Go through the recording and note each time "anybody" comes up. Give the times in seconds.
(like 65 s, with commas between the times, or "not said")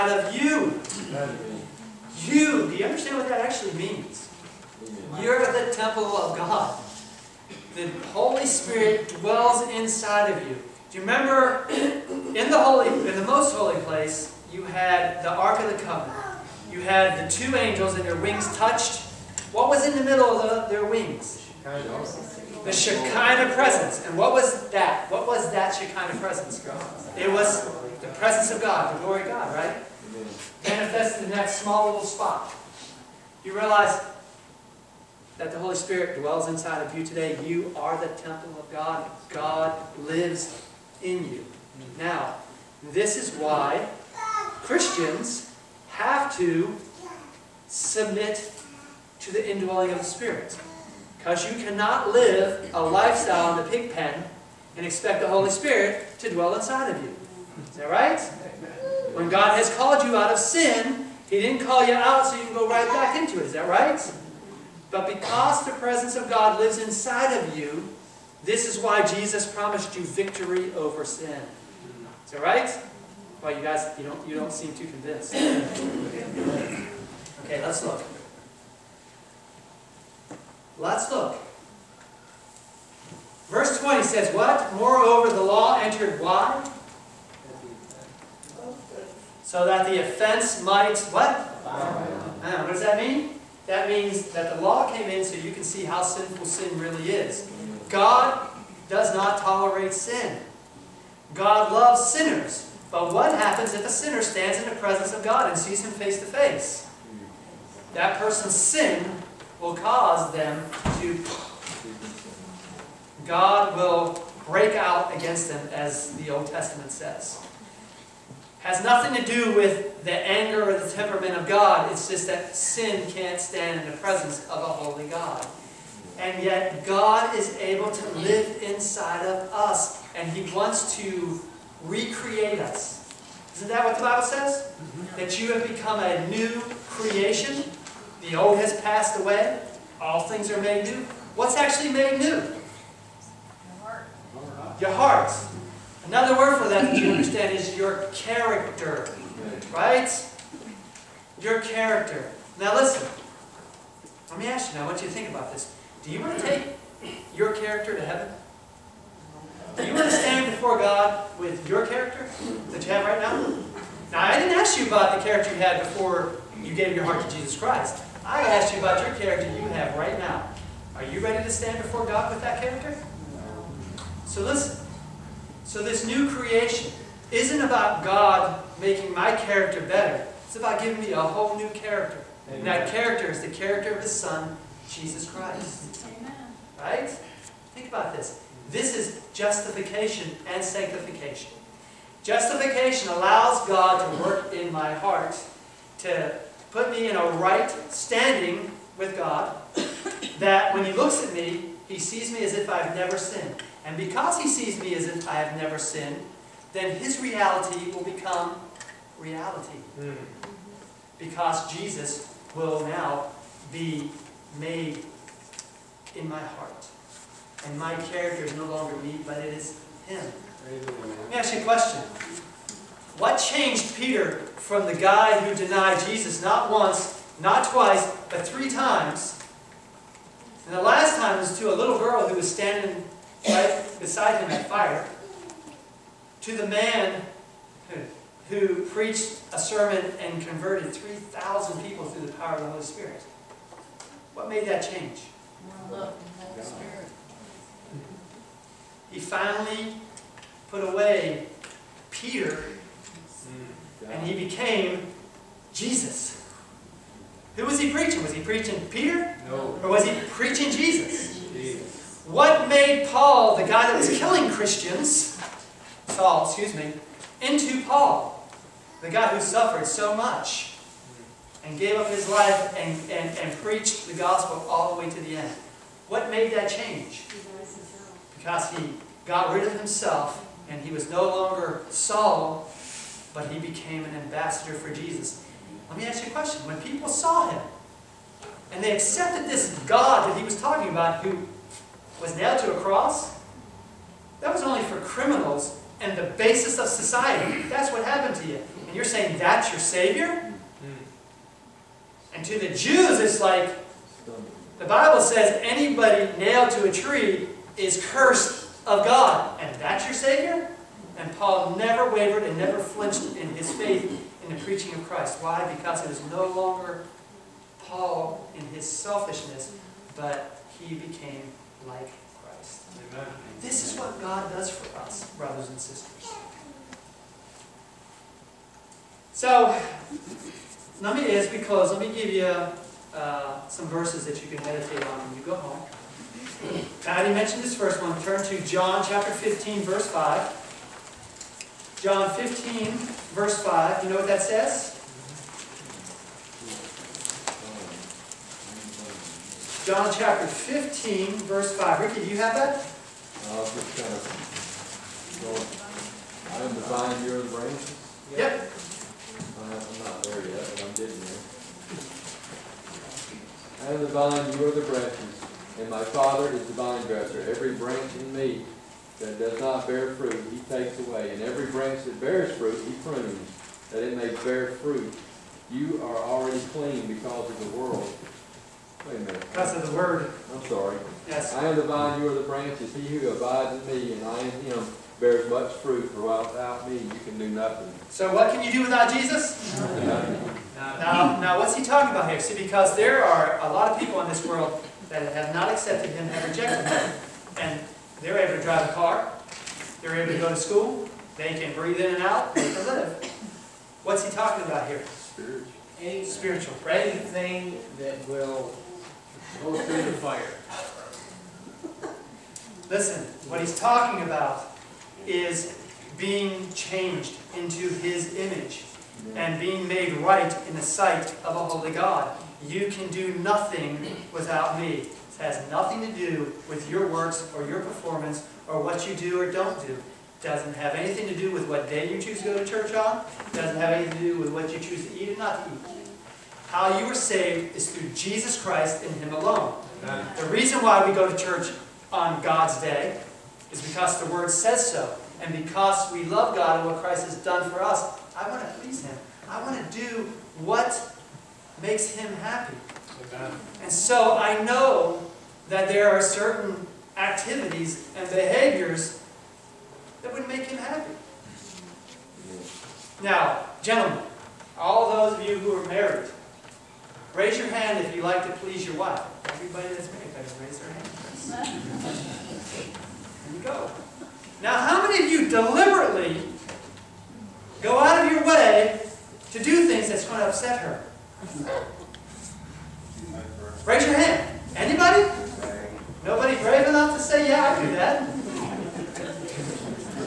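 305 s, 484 s.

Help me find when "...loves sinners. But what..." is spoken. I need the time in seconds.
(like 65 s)
101 s.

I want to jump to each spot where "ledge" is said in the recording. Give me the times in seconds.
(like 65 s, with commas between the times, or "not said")
not said.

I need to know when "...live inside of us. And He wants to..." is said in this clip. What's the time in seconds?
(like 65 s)
128 s.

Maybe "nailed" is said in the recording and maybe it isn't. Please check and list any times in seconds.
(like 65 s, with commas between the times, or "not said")
292 s, 306 s.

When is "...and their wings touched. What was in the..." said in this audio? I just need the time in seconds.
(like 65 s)
17 s.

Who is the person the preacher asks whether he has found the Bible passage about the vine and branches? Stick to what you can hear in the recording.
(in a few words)
Ricky.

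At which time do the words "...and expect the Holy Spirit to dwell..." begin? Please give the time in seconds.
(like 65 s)
54 s.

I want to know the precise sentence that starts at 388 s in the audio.
So what can you do without Jesus?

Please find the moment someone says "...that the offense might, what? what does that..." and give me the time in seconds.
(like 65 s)
89 s.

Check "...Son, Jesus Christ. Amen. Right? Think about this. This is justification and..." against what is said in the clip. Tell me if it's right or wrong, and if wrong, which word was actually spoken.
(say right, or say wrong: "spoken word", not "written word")
right.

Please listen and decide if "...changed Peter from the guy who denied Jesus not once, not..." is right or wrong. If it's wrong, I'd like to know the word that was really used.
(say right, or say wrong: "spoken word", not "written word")
right.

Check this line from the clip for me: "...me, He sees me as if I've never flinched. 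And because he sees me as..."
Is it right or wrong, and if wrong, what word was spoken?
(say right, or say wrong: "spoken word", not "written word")
wrong: "sinned", not "flinched".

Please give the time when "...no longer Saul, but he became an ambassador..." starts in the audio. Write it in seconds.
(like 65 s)
281 s.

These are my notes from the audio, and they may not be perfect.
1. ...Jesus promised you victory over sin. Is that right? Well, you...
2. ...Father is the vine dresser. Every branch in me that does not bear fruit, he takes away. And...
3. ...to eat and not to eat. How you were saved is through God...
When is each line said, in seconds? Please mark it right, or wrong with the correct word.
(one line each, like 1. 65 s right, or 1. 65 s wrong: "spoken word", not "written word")
1. 69 s right
2. 366 s right
3. 435 s wrong: "Jesus", not "God".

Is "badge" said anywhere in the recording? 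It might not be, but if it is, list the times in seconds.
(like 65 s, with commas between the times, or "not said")
not said.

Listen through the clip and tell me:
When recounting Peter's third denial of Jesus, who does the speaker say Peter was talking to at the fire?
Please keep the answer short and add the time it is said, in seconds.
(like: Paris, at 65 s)
A little girl, at 231 s.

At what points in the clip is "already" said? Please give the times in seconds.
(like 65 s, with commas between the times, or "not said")
337 s, 376 s.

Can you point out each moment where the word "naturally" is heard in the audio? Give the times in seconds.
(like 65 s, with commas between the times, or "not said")
not said.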